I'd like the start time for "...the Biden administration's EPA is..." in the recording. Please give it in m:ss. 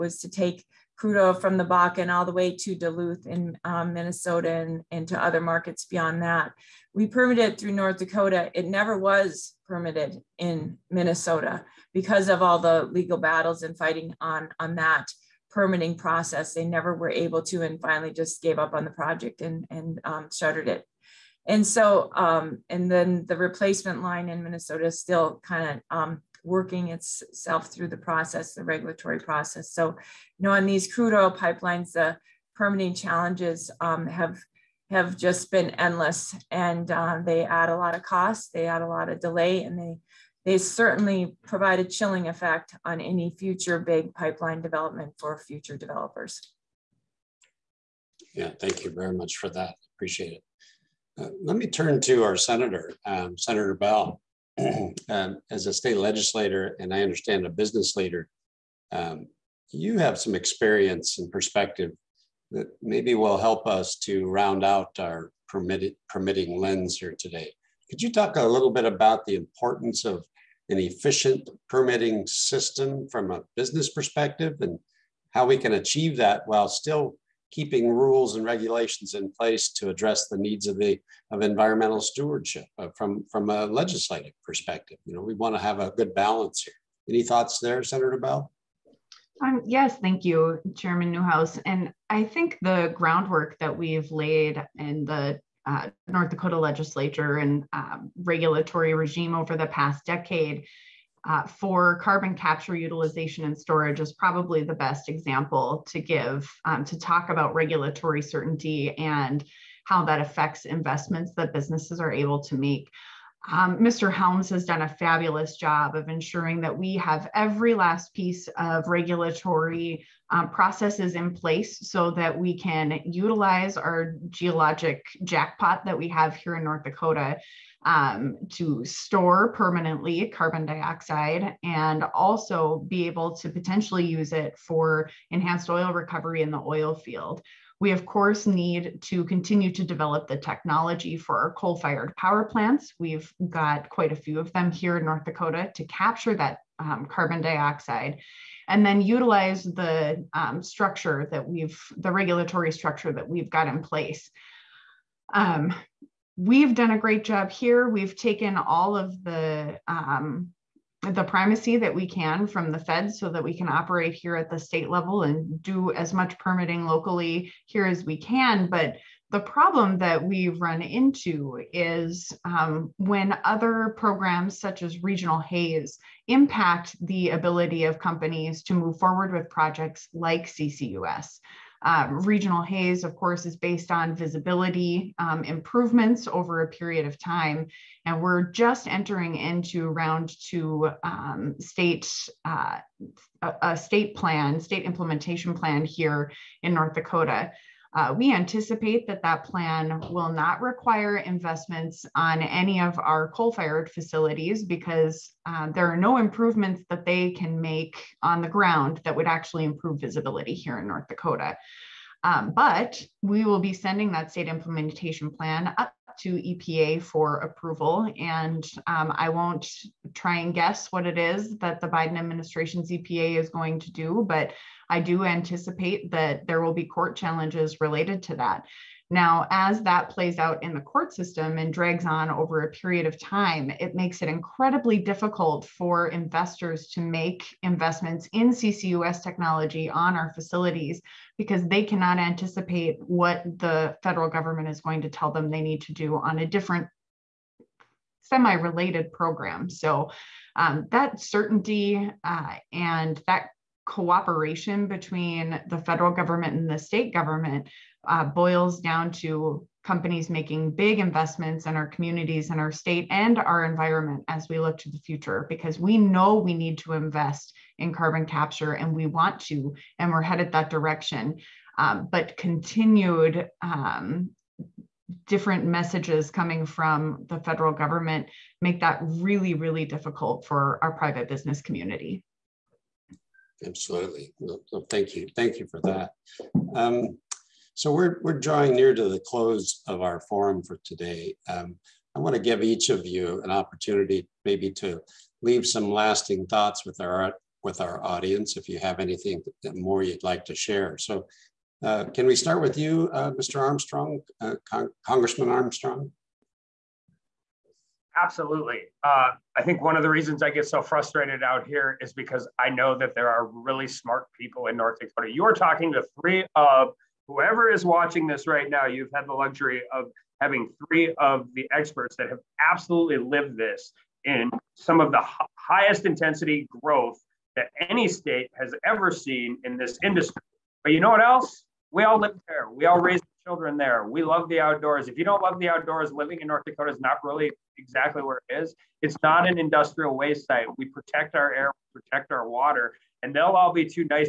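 3:41.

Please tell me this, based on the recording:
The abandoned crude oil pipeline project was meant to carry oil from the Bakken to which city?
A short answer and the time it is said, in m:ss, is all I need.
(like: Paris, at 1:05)
Duluth, at 0:02.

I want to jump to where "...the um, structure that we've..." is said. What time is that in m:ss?
2:29.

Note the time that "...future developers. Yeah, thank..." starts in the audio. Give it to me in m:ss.
0:45.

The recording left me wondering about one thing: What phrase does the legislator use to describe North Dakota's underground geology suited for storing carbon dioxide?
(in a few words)
geologic jackpot.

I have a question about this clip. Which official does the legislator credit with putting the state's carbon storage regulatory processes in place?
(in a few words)
Mr. Helms.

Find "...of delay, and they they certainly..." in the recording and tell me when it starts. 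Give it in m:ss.
0:39.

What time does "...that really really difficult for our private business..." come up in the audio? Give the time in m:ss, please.
4:38.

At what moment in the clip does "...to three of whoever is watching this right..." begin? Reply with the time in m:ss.
5:15.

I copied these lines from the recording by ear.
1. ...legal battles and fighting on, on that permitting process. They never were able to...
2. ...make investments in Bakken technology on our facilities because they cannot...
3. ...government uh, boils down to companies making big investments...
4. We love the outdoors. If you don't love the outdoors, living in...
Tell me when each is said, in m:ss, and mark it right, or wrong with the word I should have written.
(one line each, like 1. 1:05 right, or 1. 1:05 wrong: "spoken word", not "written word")
1. 0:12 right
2. 3:56 wrong: "CCUS", not "Bakken"
3. 4:17 right
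4. 5:34 right.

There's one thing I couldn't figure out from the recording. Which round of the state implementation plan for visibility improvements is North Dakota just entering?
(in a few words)
Round two.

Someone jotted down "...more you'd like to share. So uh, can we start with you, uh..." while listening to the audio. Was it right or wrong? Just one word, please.
right.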